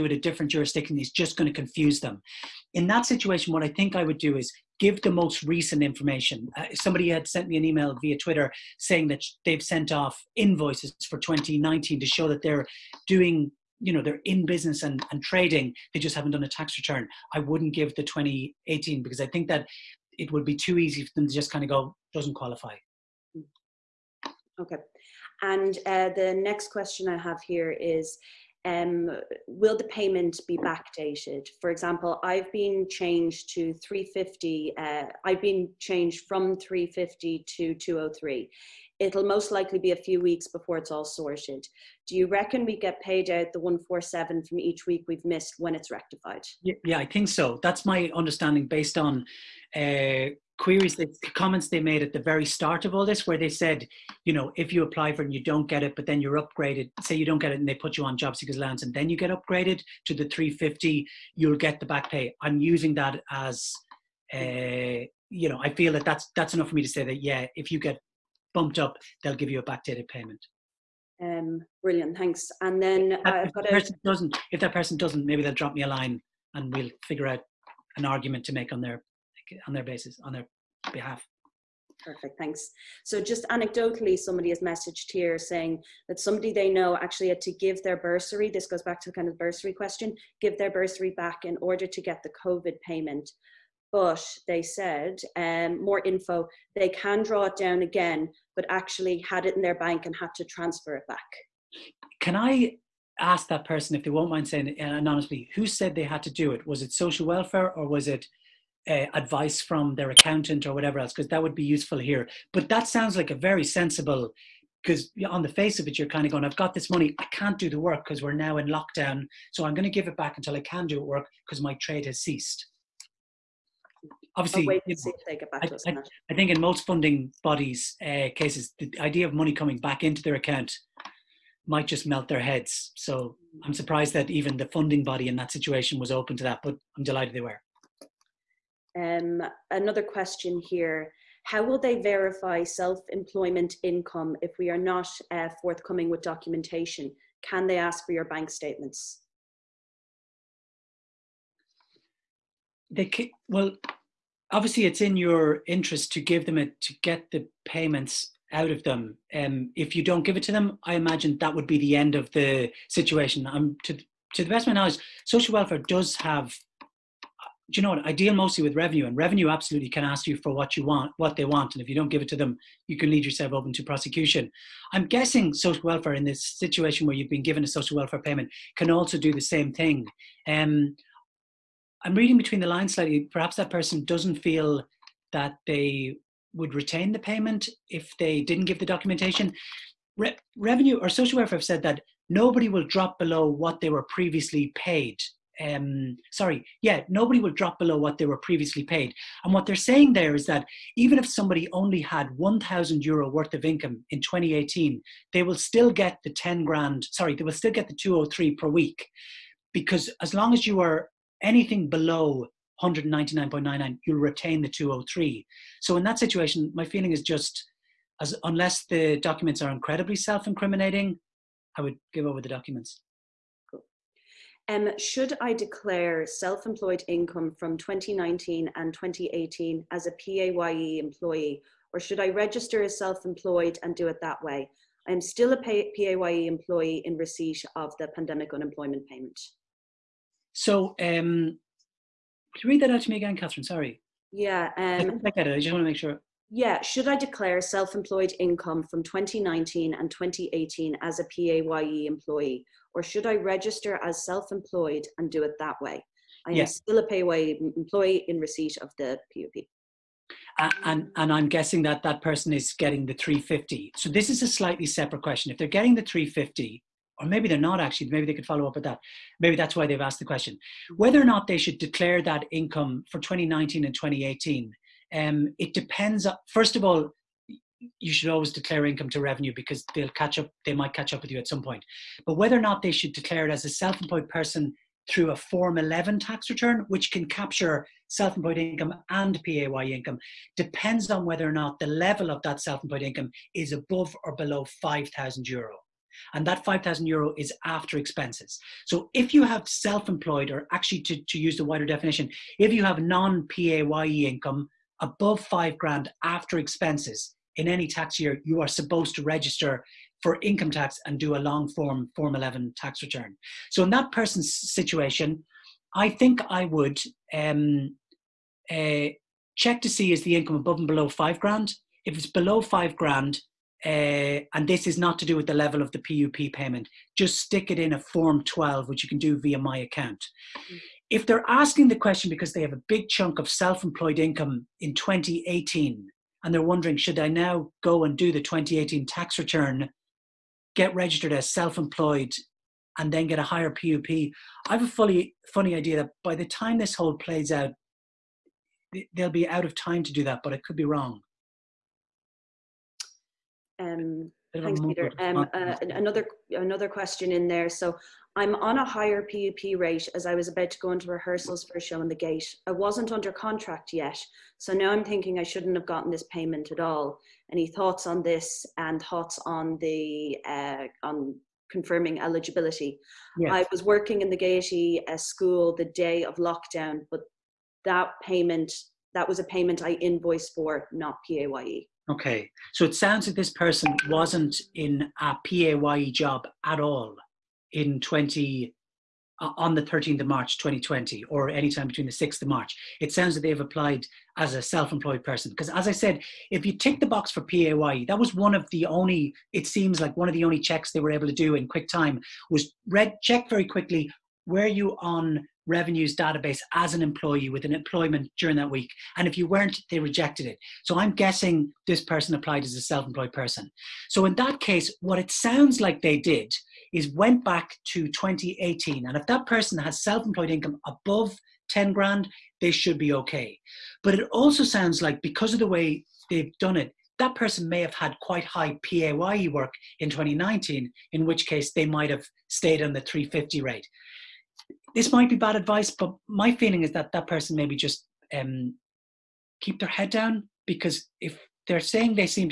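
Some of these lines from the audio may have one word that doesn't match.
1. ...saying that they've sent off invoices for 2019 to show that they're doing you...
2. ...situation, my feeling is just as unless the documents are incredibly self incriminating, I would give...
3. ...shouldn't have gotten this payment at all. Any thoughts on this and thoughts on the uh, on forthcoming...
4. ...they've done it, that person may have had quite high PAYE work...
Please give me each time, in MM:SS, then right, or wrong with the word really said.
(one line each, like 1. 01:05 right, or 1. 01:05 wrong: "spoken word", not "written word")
1. 00:08 right
2. 03:36 right
3. 06:05 wrong: "confirming", not "forthcoming"
4. 07:06 right.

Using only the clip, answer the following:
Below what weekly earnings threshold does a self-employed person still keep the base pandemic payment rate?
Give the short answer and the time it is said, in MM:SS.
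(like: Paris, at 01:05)
199.99, at 03:32.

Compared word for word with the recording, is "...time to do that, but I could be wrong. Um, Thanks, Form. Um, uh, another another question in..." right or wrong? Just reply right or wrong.
wrong.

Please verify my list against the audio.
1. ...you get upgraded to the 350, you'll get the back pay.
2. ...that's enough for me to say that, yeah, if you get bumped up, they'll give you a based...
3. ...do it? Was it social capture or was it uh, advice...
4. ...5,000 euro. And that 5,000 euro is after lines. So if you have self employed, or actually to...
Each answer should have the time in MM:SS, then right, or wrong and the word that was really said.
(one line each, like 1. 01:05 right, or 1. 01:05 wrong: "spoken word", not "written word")
1. 00:59 right
2. 01:06 wrong: "backdated", not "based"
3. 01:46 wrong: "welfare", not "capture"
4. 04:54 wrong: "expenses", not "lines".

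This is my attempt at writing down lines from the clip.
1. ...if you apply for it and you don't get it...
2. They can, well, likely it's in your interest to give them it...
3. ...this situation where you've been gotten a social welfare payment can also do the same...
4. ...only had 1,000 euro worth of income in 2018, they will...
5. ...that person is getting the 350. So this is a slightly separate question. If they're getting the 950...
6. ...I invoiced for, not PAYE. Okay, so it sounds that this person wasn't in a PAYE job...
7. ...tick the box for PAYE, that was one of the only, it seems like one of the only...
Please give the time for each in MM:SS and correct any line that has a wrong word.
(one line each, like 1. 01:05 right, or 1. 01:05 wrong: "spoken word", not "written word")
1. 00:54 right
2. 02:32 wrong: "obviously", not "likely"
3. 02:56 wrong: "given", not "gotten"
4. 03:21 right
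5. 04:22 wrong: "350", not "950"
6. 06:19 right
7. 06:36 right.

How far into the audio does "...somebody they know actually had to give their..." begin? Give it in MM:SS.
01:26.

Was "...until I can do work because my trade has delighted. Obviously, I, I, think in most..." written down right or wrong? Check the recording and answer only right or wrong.
wrong.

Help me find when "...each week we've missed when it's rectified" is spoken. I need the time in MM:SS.
00:44.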